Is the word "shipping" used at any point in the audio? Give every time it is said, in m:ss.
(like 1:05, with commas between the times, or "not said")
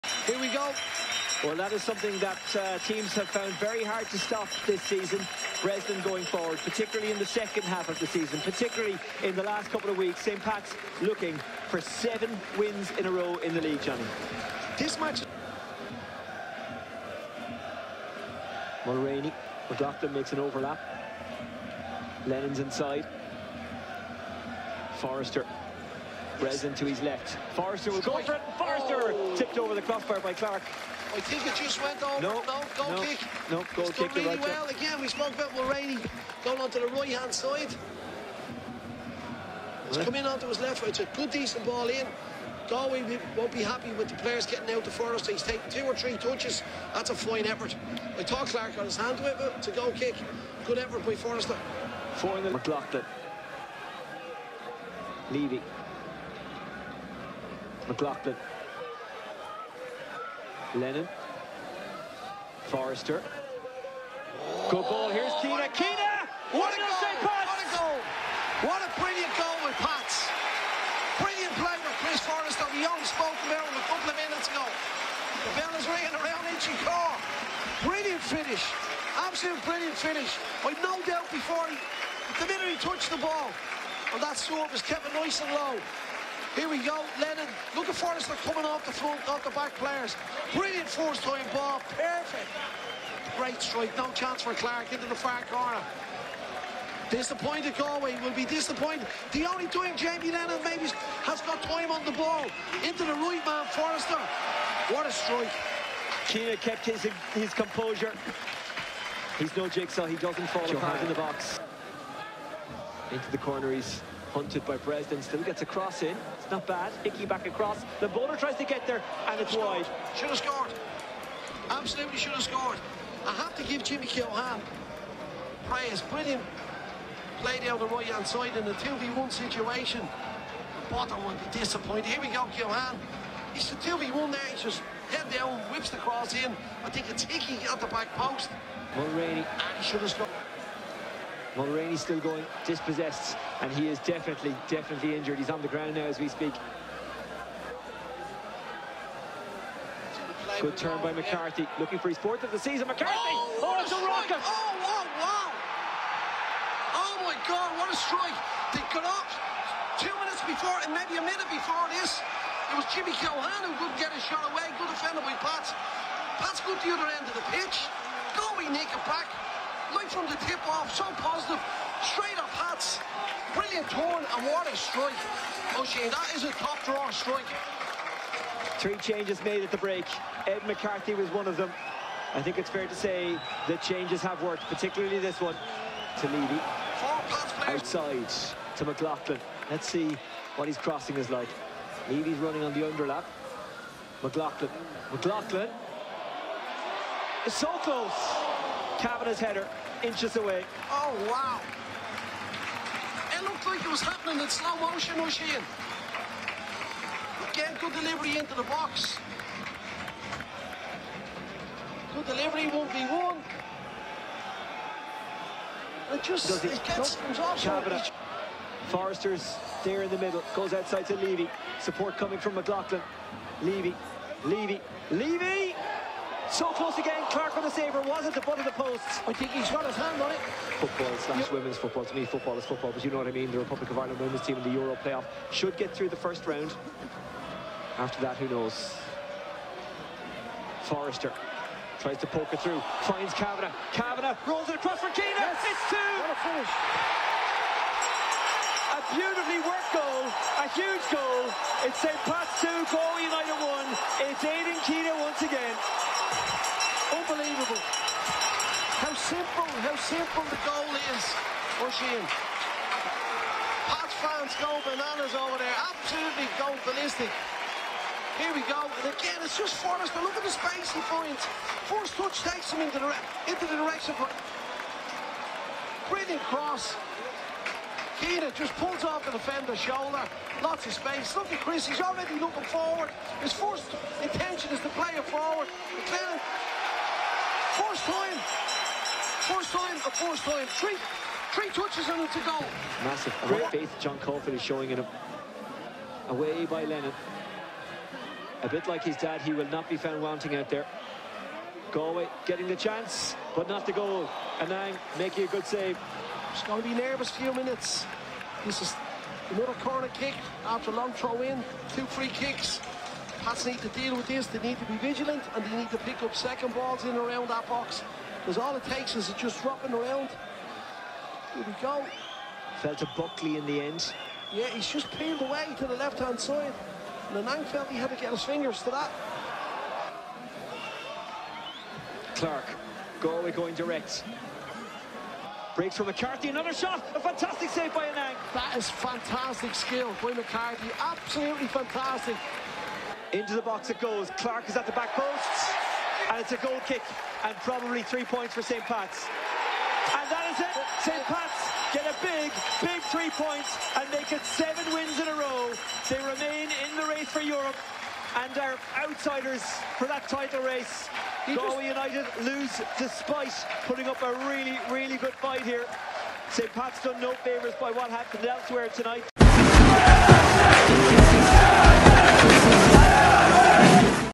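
not said.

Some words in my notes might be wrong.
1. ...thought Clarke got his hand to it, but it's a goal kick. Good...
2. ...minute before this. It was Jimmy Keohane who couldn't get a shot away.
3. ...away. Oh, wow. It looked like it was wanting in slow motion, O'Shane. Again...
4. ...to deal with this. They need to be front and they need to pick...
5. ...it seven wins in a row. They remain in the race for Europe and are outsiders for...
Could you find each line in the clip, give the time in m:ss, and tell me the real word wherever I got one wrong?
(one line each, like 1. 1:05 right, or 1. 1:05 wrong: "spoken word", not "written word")
1. 0:48 right
2. 2:41 right
3. 3:20 wrong: "happening", not "wanting"
4. 5:13 wrong: "vigilant", not "front"
5. 5:54 right.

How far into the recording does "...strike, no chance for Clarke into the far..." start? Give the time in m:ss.
1:33.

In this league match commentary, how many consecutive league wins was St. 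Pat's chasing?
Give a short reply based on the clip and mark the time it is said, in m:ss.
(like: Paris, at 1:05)
7, at 0:11.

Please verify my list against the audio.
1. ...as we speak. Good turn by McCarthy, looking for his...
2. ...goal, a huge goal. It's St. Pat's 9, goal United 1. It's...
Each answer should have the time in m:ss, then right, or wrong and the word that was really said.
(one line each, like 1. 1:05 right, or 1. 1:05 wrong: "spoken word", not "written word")
1. 2:26 right
2. 4:09 wrong: "2", not "9".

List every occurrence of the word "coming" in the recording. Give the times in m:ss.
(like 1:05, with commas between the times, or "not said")
1:28, 3:42.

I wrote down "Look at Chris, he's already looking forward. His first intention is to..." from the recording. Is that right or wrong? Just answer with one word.
right.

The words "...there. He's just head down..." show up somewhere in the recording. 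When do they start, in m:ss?
2:14.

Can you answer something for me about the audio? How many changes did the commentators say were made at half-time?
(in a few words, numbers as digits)
3.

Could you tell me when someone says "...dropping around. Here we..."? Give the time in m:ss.
5:19.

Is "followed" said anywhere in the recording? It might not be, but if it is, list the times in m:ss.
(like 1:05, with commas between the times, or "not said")
not said.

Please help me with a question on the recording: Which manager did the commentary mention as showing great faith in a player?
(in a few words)
John Caulfield.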